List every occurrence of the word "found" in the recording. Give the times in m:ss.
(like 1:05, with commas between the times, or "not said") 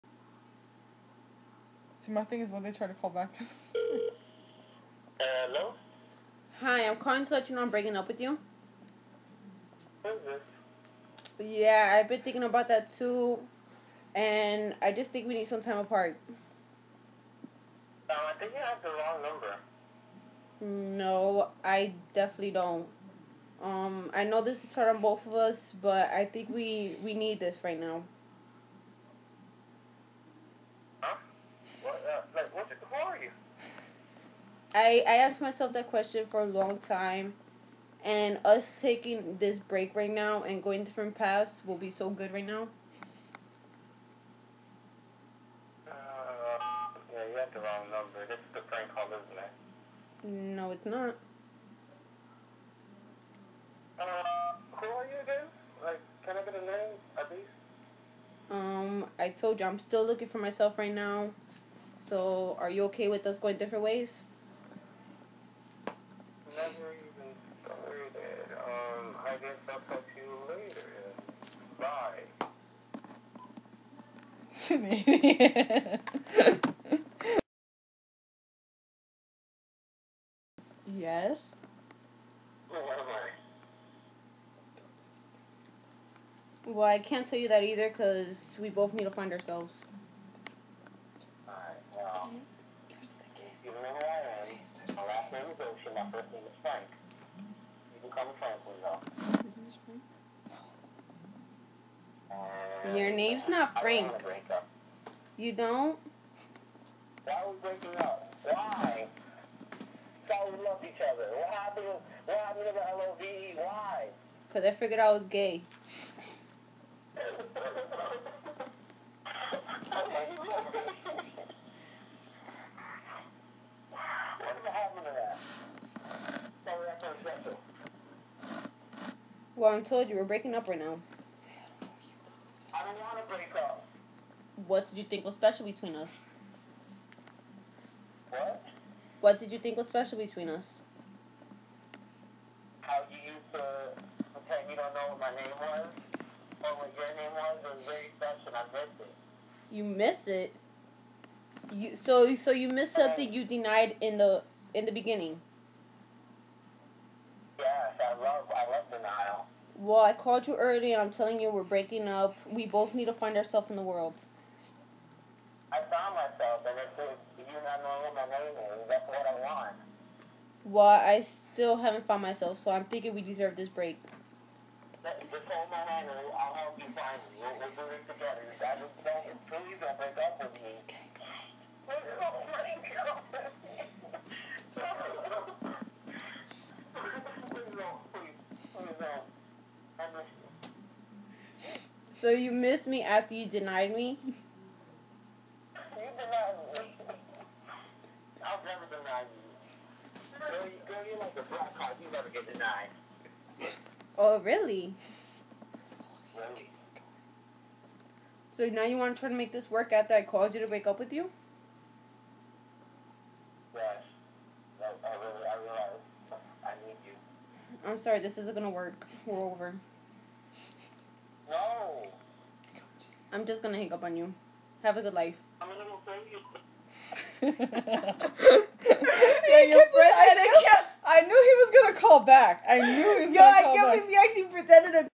2:45, 2:52.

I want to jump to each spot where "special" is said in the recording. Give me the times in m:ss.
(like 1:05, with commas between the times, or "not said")
2:15, 2:19, 2:28.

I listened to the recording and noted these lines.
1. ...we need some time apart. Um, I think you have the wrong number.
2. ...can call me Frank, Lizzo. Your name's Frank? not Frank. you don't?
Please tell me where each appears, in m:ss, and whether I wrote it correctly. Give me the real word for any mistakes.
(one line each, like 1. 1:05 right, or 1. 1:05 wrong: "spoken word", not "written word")
1. 0:15 right
2. 1:38 right.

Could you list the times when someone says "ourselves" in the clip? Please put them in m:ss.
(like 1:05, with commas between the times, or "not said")
1:29, 2:43.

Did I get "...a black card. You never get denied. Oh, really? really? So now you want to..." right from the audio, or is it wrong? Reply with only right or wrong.
right.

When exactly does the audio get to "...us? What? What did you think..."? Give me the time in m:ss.
2:15.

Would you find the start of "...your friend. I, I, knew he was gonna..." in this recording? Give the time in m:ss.
3:49.